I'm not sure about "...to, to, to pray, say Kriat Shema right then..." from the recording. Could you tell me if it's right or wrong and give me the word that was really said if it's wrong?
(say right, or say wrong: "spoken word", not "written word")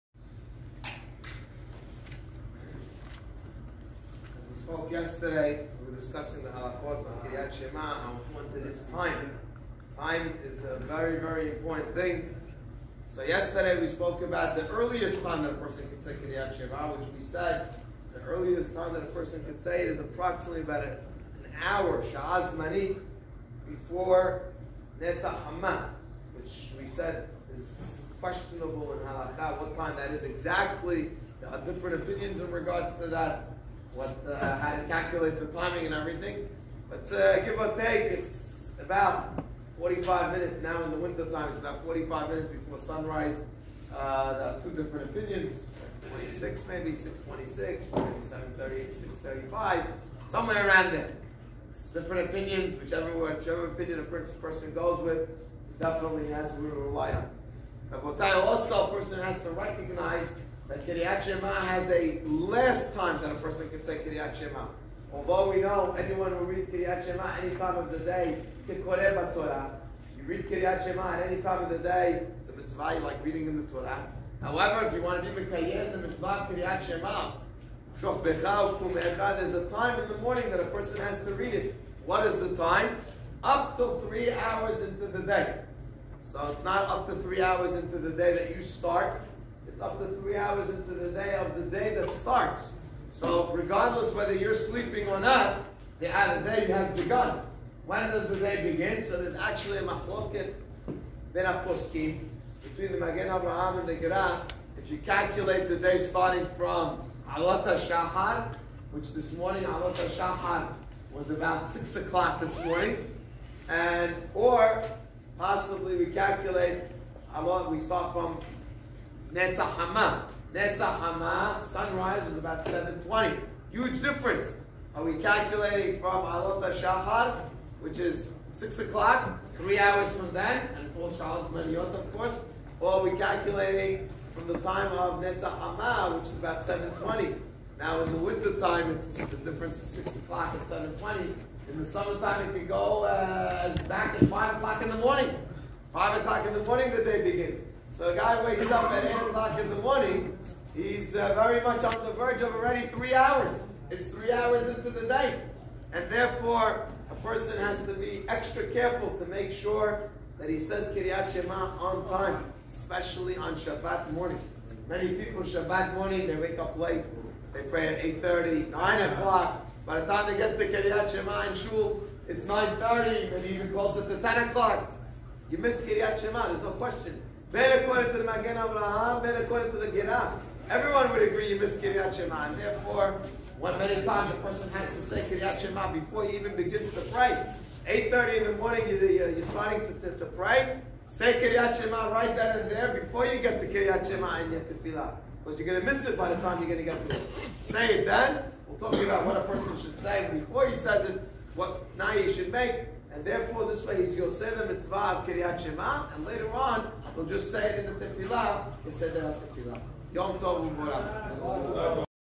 right.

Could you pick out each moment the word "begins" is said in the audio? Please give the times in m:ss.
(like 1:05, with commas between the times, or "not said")
1:38, 2:27, 3:06.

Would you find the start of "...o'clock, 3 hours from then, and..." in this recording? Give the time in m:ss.
2:08.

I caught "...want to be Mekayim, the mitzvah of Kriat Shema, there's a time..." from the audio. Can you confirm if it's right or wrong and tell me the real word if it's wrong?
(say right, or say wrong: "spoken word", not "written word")
right.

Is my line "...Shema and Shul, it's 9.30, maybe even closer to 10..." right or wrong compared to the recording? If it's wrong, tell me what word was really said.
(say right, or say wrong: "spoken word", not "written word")
right.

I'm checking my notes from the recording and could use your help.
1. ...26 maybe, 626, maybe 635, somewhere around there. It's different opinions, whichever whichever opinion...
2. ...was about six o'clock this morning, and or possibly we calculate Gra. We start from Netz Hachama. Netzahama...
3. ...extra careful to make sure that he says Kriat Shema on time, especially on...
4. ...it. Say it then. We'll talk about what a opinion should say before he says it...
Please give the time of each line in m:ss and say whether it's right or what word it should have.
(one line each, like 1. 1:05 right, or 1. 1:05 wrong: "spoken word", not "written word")
1. 0:46 right
2. 1:51 wrong: "Alot", not "Gra"
3. 2:38 right
4. 3:17 wrong: "person", not "opinion".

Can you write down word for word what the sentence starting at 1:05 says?
Although we know anyone who reads Kriat Shema any time of the day, Kikoreh Torah.